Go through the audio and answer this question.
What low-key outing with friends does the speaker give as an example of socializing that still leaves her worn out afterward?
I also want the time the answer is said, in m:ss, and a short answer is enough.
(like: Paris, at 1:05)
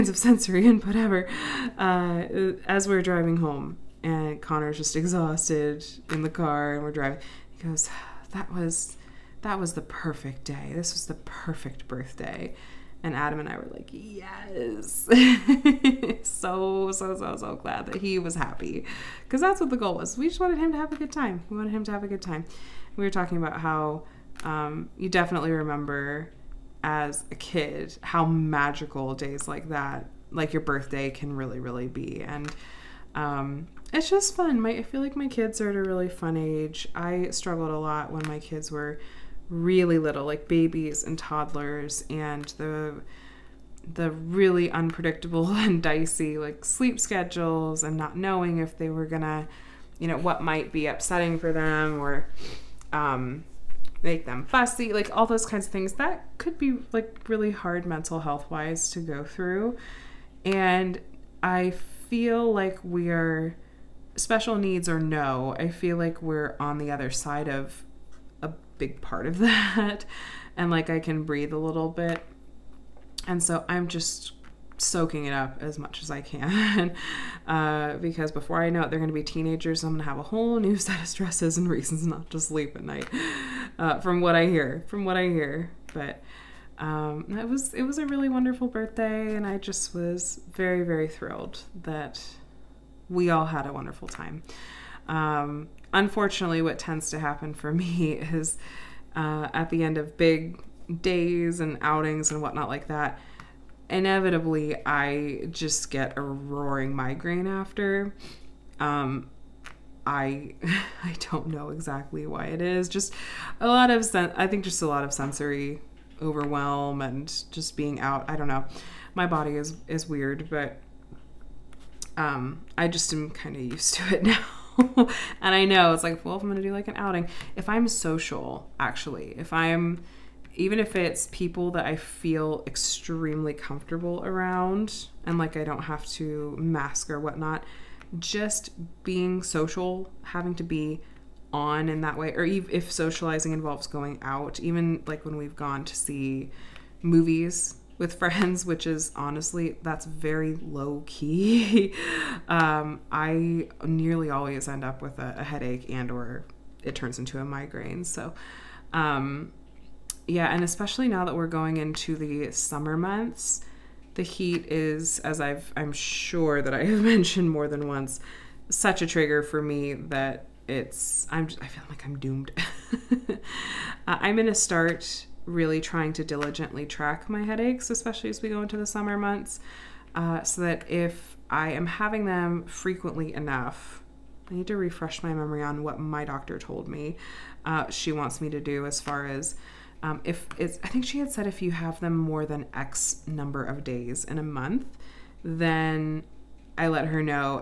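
movies, at 2:27.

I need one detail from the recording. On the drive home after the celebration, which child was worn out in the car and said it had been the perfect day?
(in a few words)
Connor.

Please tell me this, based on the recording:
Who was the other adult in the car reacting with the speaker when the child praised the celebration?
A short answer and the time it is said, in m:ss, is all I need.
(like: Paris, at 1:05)
Adam, at 0:13.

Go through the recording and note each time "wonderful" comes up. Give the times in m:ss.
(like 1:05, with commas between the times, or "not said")
1:28, 1:33.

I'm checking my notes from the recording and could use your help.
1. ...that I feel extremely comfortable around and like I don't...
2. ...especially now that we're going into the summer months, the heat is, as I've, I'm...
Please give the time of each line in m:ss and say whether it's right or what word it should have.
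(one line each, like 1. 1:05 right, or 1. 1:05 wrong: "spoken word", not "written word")
1. 2:11 right
2. 2:40 right.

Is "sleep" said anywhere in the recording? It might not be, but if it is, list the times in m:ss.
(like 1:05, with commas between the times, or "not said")
0:46, 1:22.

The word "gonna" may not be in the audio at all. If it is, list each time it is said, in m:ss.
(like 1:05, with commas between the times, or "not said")
0:49, 2:54.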